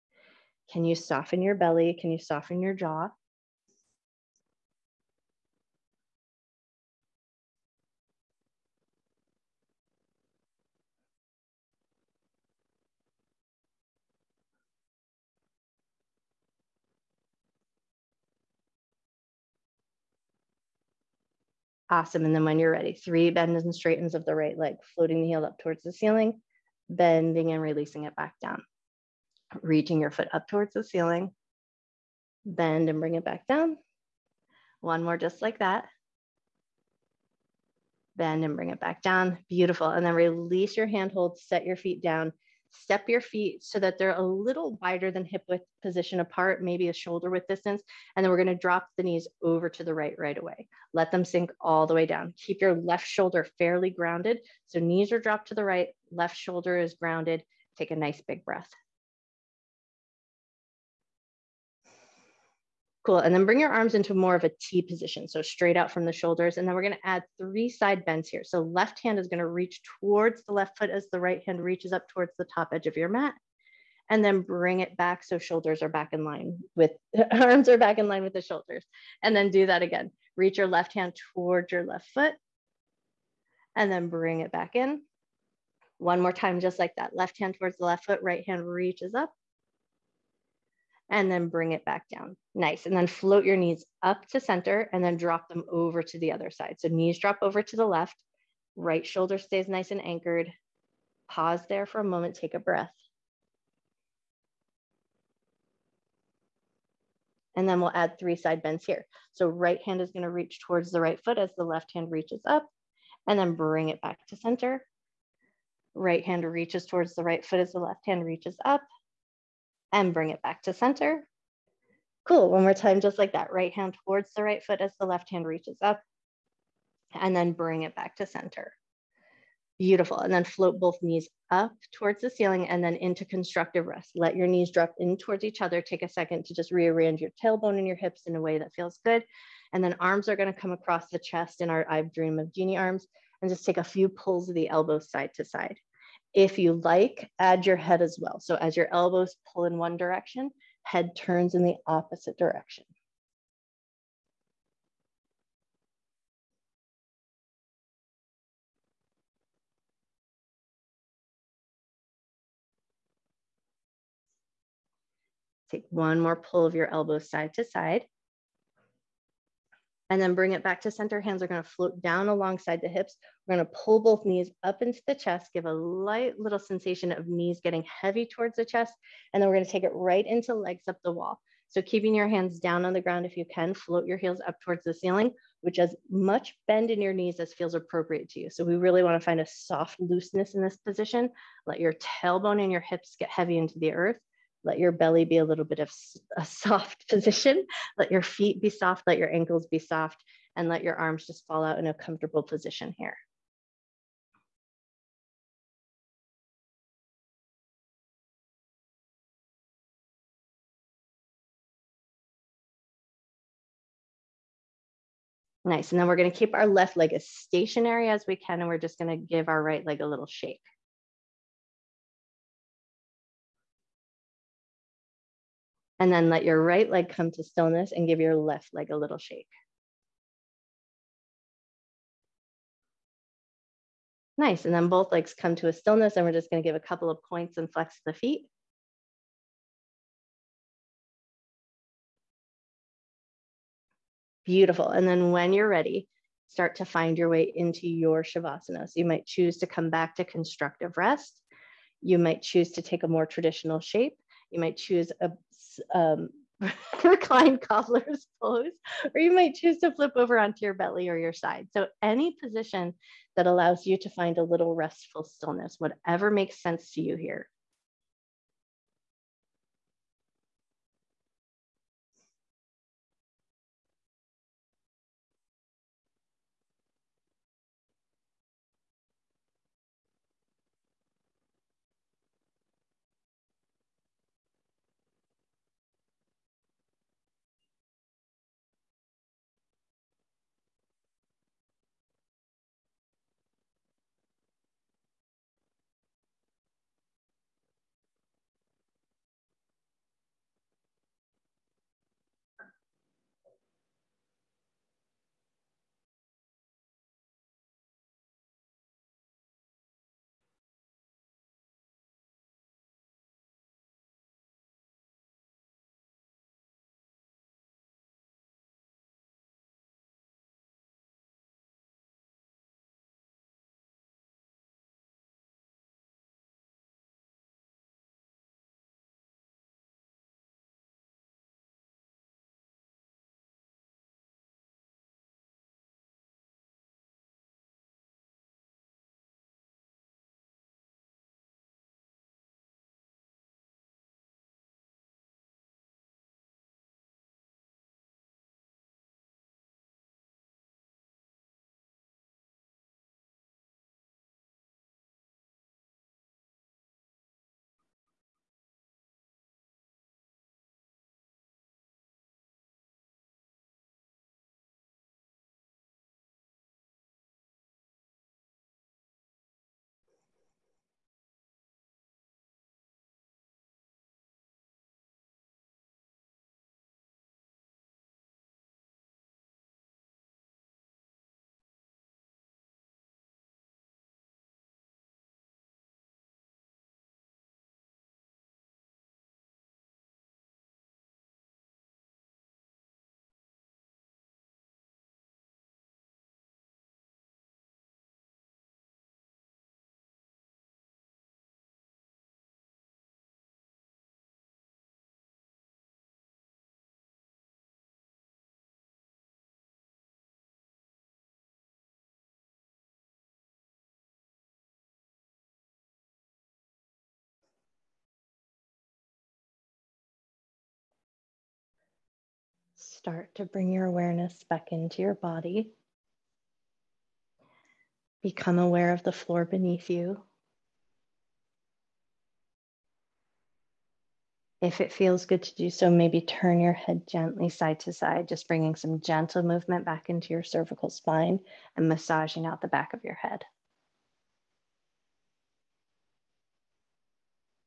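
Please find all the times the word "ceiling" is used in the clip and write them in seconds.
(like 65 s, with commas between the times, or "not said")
25 s, 30 s, 132 s, 184 s.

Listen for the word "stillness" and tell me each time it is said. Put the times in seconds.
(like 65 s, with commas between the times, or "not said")
227 s, 235 s, 265 s.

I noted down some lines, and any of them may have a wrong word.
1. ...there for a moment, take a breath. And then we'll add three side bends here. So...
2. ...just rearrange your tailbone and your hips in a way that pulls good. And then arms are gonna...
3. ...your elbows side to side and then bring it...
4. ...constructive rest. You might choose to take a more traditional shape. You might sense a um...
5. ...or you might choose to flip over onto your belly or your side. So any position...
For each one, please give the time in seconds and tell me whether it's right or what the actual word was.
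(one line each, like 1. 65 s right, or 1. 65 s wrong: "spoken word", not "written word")
1. 101 s right
2. 136 s wrong: "feels", not "pulls"
3. 166 s right
4. 250 s wrong: "choose", not "sense"
5. 259 s right.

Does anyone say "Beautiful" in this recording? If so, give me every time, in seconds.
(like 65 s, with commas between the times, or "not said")
39 s, 129 s, 244 s.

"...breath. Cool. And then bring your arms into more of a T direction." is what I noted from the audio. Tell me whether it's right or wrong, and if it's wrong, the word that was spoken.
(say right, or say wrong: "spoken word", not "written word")
wrong: "position", not "direction".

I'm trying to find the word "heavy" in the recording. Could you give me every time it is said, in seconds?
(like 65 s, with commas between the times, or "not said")
178 s, 193 s.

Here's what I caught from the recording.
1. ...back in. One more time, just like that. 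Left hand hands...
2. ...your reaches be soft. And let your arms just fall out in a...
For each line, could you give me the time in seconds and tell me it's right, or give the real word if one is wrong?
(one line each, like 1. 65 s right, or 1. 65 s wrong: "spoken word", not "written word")
1. 84 s wrong: "towards", not "hands"
2. 199 s wrong: "ankles", not "reaches".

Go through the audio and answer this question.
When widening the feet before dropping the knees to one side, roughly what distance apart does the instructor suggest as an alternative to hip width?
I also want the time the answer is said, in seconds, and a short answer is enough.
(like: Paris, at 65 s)
shoulder width, at 46 s.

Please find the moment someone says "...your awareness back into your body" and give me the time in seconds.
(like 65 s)
423 s.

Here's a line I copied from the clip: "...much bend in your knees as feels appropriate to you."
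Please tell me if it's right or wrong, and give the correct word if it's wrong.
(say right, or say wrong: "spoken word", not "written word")
right.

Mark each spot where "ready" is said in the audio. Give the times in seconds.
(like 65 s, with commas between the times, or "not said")
22 s, 245 s.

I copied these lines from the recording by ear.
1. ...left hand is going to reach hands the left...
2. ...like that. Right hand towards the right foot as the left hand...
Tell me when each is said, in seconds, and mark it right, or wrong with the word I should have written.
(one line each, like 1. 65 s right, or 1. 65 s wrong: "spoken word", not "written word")
1. 68 s wrong: "towards", not "hands"
2. 123 s right.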